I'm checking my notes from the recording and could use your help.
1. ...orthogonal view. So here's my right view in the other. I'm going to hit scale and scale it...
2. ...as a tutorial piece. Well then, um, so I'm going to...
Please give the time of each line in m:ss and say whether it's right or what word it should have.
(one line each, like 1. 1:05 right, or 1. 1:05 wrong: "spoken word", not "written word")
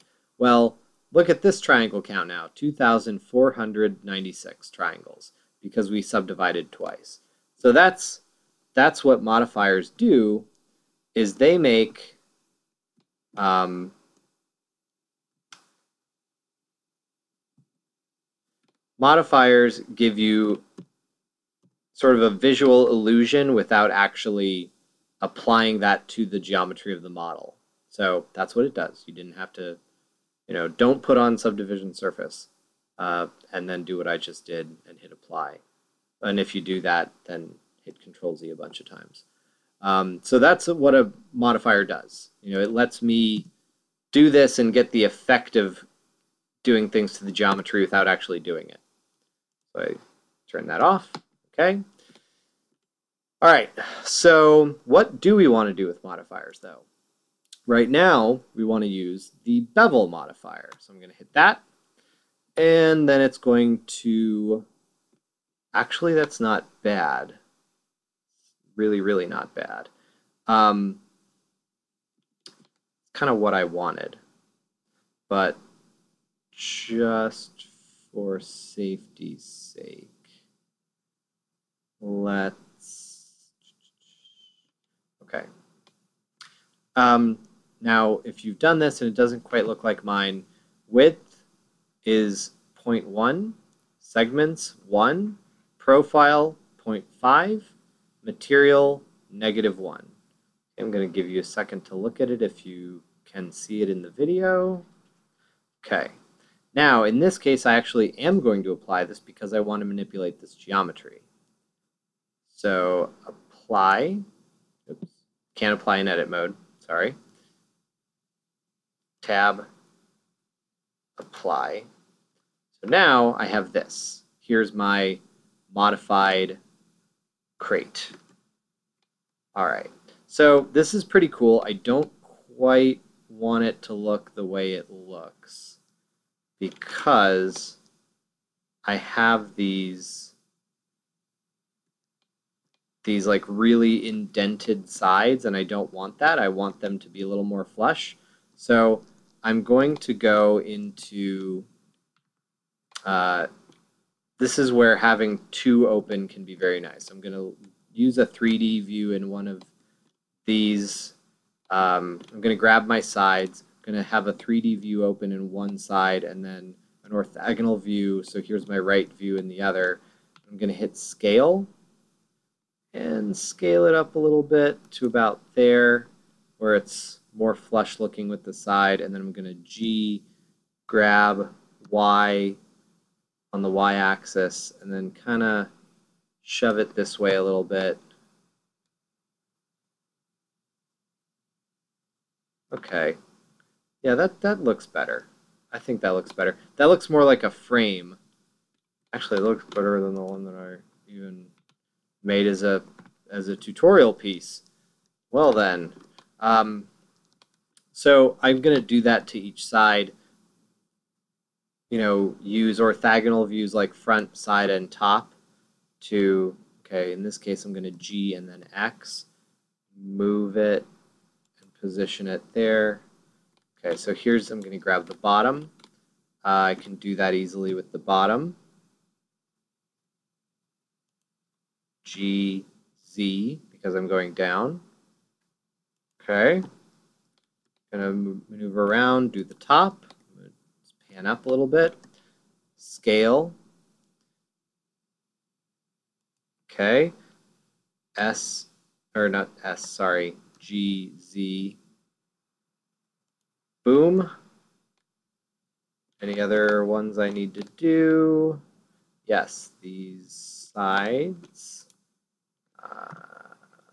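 1. 2:47 right
2. 3:23 right.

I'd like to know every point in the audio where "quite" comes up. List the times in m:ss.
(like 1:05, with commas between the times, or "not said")
1:29, 2:12.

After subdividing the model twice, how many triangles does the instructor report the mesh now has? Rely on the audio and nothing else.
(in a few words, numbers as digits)
2,496.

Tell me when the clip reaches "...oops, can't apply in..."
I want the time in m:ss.
1:54.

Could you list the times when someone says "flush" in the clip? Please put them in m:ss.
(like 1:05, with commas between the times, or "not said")
2:27, 2:57.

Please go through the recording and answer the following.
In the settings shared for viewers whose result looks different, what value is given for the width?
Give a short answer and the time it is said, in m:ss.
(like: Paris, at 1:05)
0.1, at 1:32.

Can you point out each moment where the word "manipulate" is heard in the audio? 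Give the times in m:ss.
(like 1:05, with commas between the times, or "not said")
1:49.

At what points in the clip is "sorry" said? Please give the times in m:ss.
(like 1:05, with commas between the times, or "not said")
1:56, 4:09.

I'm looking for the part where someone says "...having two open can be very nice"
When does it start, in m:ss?
2:34.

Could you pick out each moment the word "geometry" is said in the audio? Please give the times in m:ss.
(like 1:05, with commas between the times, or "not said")
0:26, 0:47, 1:50.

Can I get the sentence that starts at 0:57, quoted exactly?
Right now, we want to use the bevel modifier.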